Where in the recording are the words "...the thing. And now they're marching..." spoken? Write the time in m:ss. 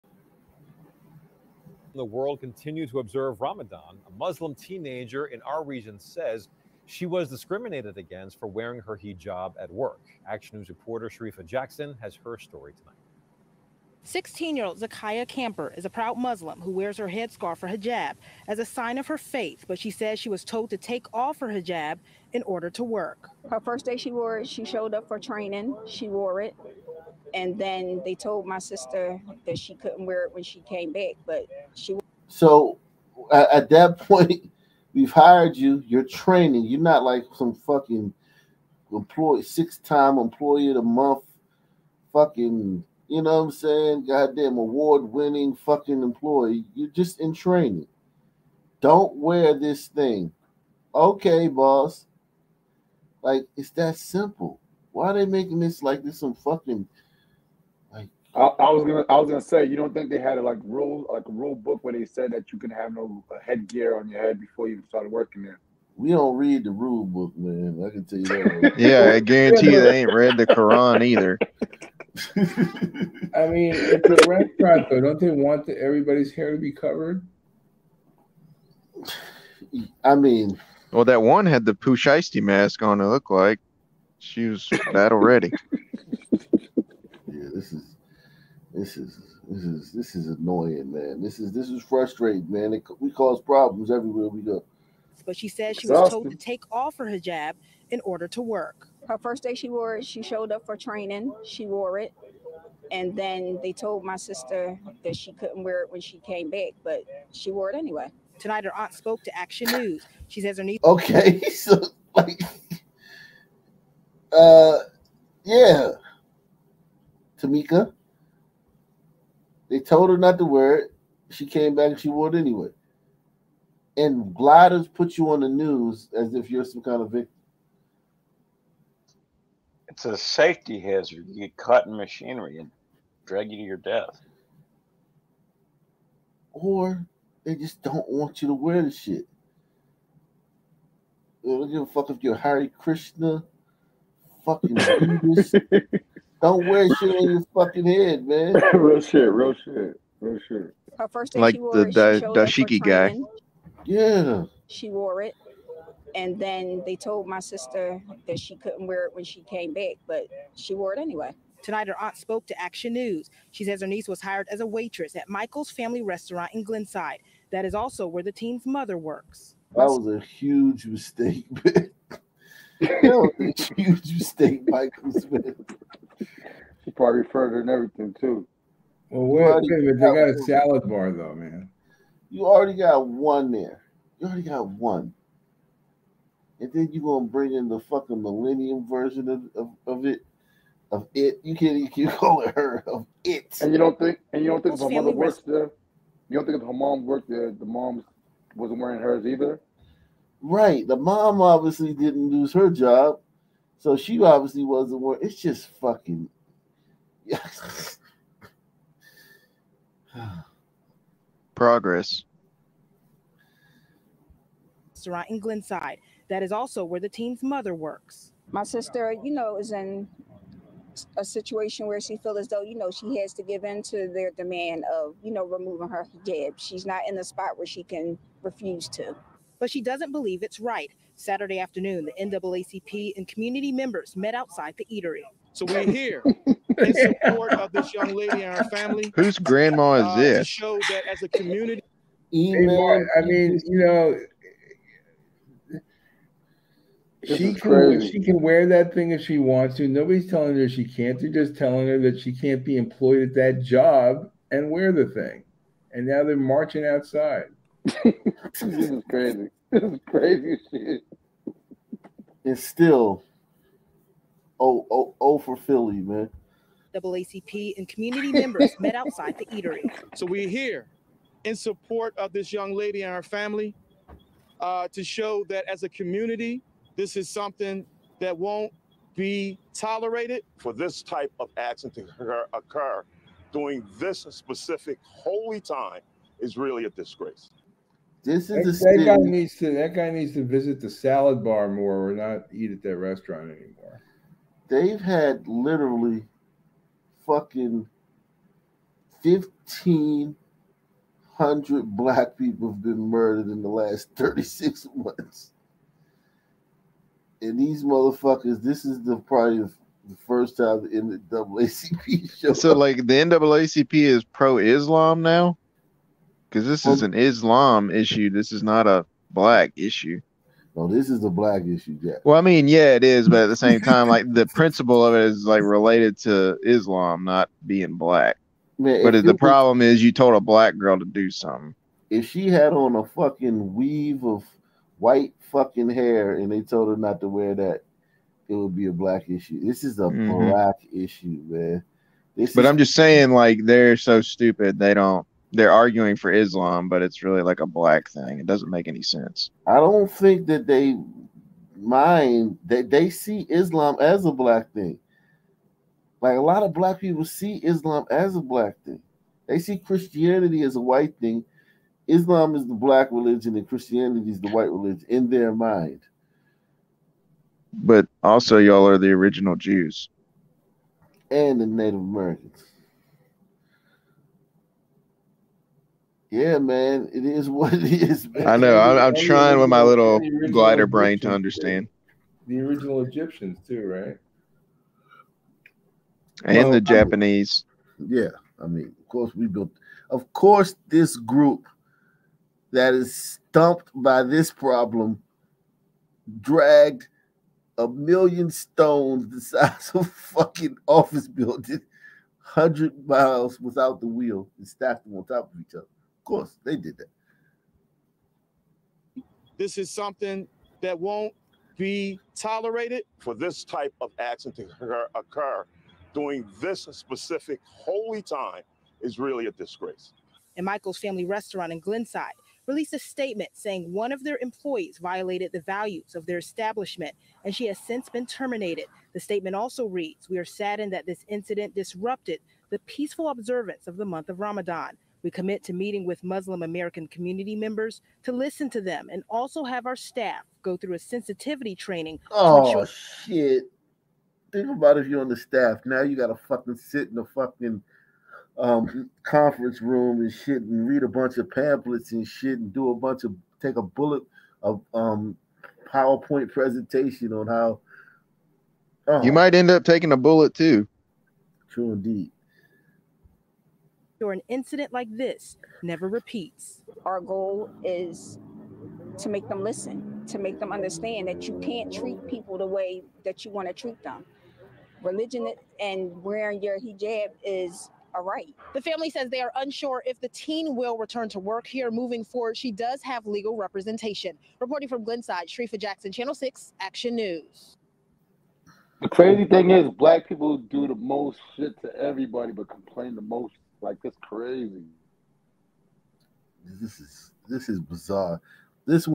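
4:14.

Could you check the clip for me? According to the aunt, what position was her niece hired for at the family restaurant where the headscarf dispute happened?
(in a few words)
waitress.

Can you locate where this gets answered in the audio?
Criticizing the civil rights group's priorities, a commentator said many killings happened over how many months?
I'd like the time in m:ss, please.
5:04.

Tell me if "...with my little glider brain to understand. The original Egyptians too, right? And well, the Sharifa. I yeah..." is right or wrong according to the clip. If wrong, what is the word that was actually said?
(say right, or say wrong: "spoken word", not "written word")
wrong: "Japanese", not "Sharifa".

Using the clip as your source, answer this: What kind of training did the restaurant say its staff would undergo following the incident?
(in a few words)
sensitivity training.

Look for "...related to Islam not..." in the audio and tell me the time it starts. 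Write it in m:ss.
5:25.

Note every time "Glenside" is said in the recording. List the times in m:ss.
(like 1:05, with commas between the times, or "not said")
2:46, 3:35, 7:01, 8:05.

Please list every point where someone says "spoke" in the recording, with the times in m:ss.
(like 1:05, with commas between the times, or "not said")
1:48, 2:42.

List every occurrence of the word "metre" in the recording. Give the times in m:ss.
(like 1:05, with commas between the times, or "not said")
not said.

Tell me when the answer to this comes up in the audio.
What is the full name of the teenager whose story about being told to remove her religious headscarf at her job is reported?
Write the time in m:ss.
0:14.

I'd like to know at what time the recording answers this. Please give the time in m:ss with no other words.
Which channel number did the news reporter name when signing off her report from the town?
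8:06.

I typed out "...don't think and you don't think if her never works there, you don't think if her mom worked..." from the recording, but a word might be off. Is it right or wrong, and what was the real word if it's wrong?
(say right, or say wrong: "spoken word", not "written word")
wrong: "mother", not "never".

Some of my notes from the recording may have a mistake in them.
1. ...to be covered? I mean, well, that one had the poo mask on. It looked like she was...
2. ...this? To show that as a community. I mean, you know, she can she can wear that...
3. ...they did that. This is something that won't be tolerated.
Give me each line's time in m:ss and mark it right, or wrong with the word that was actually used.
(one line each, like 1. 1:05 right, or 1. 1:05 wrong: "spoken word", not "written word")
1. 1:16 right
2. 4:00 right
3. 6:46 right.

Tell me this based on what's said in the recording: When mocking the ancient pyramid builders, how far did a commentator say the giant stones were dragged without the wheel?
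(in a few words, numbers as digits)
100 miles.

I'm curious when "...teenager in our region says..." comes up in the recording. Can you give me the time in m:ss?
0:04.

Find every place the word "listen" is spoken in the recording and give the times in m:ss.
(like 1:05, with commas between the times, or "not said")
7:18, 7:49.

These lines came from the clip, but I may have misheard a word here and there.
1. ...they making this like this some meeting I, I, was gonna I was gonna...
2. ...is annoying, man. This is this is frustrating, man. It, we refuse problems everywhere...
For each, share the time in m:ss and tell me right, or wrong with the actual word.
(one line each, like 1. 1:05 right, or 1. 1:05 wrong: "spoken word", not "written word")
1. 0:55 wrong: "fucking", not "meeting"
2. 1:30 wrong: "cause", not "refuse".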